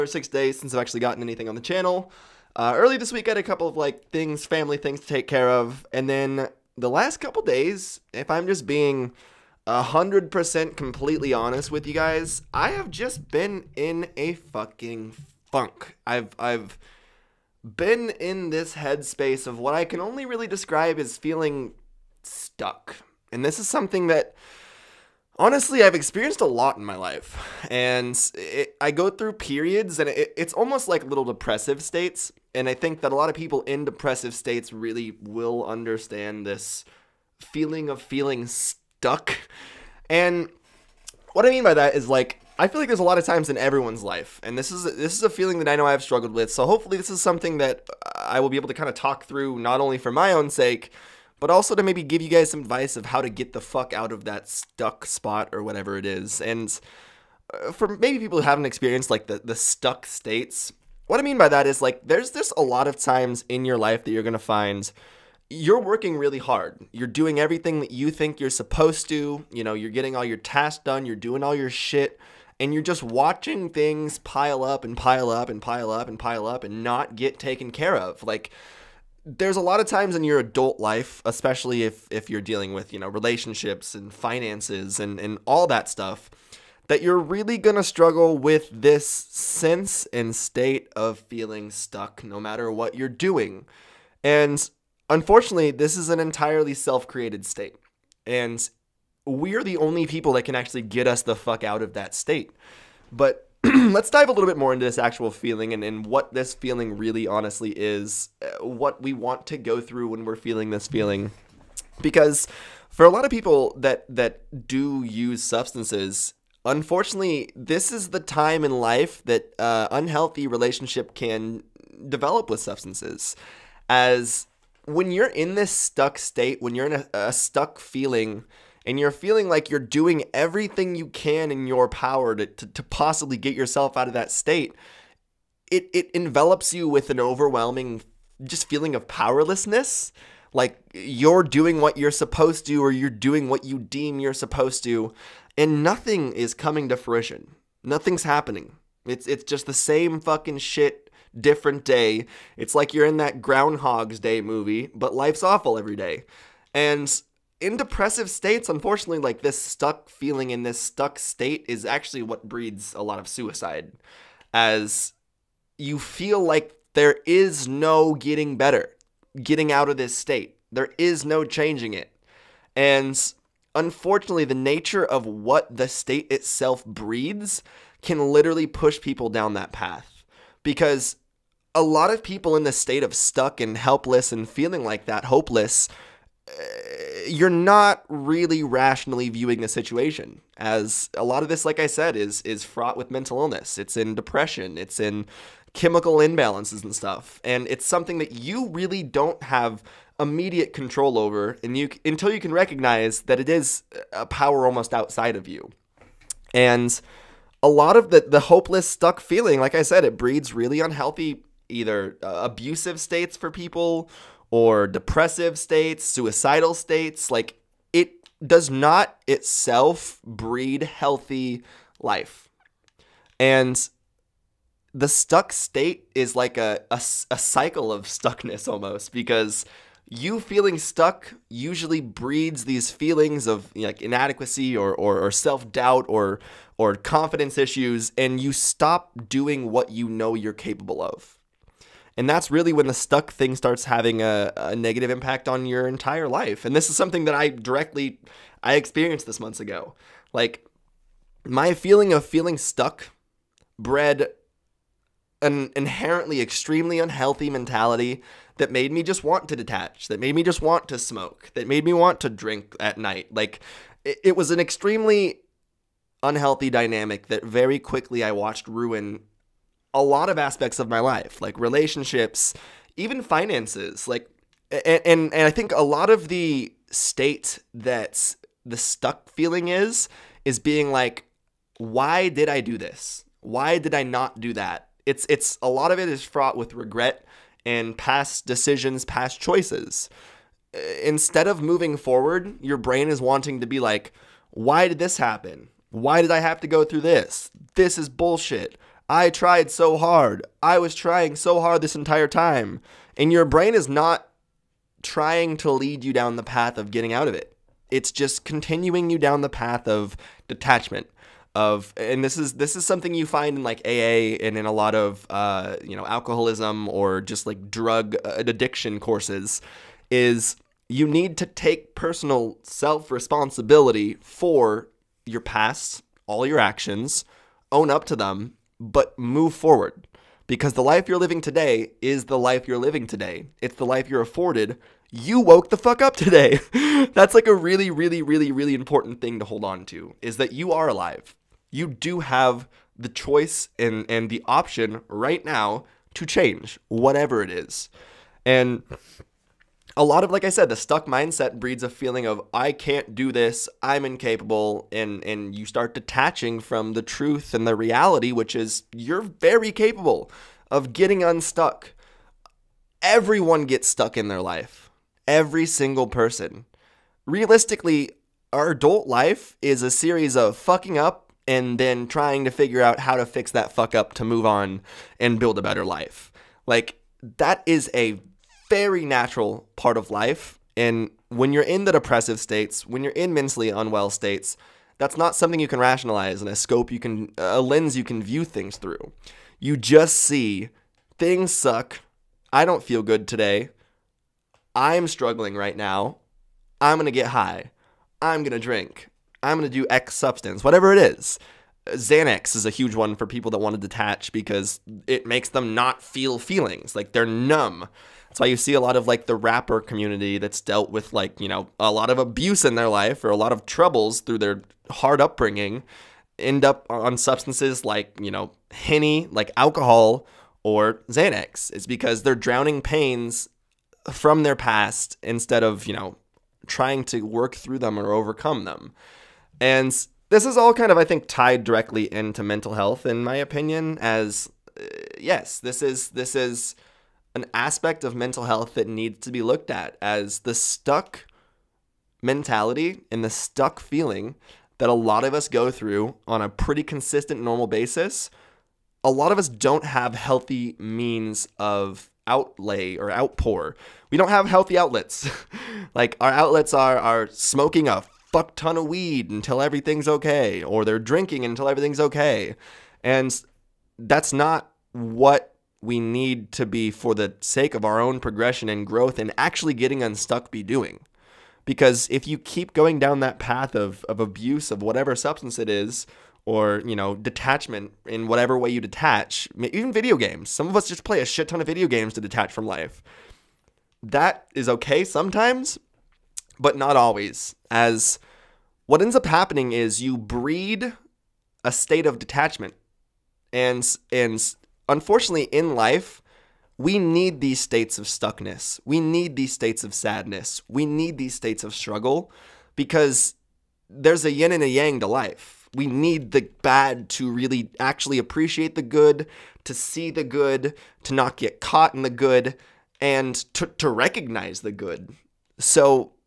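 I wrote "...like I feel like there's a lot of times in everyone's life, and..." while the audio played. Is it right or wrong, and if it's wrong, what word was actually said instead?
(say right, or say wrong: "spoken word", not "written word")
right.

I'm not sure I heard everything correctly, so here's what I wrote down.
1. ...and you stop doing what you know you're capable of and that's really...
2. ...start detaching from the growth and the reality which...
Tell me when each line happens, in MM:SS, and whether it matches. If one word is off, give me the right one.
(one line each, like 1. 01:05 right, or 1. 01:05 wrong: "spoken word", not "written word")
1. 03:58 right
2. 05:55 wrong: "truth", not "growth".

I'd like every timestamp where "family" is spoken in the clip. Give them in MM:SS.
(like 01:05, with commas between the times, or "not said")
00:04.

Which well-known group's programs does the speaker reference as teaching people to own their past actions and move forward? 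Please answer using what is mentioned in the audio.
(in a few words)
AA.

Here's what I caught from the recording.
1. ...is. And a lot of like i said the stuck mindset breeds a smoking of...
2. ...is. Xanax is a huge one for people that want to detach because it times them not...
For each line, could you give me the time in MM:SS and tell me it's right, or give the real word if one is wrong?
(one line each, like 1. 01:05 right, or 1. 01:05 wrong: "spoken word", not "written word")
1. 05:47 wrong: "feeling", not "smoking"
2. 06:40 wrong: "makes", not "times".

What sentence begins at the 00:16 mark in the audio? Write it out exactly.
I've I've been in this headspace of what I can only really describe as feeling stuck.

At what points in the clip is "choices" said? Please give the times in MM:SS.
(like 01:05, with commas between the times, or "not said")
04:49, 05:43.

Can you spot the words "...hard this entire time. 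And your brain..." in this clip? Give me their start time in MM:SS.
05:01.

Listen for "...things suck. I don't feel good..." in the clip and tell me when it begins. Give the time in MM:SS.
06:31.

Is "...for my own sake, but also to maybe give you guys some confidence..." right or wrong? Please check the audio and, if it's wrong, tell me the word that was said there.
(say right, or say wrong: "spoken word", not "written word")
wrong: "advice", not "confidence".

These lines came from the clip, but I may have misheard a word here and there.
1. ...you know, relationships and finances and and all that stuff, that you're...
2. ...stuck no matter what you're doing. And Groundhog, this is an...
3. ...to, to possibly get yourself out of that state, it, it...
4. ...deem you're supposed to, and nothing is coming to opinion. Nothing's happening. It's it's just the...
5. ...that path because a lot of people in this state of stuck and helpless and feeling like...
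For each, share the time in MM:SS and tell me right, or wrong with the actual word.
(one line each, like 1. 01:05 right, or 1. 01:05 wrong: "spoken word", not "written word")
1. 01:22 right
2. 01:31 wrong: "Unfortunately", not "Groundhog"
3. 02:12 right
4. 02:23 wrong: "fruition", not "opinion"
5. 02:59 right.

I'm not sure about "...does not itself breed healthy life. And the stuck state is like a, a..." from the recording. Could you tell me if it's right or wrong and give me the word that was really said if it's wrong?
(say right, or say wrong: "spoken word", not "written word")
right.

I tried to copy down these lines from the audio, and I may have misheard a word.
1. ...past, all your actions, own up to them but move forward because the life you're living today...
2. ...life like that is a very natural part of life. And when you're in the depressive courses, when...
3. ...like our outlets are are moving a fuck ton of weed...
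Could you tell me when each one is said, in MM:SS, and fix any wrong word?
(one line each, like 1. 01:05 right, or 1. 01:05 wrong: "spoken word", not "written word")
1. 05:25 right
2. 06:15 wrong: "states", not "courses"
3. 07:35 wrong: "smoking", not "moving".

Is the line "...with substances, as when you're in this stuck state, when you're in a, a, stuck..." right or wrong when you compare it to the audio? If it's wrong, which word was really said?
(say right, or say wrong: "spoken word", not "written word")
right.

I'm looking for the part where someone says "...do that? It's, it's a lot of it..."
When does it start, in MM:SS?
04:44.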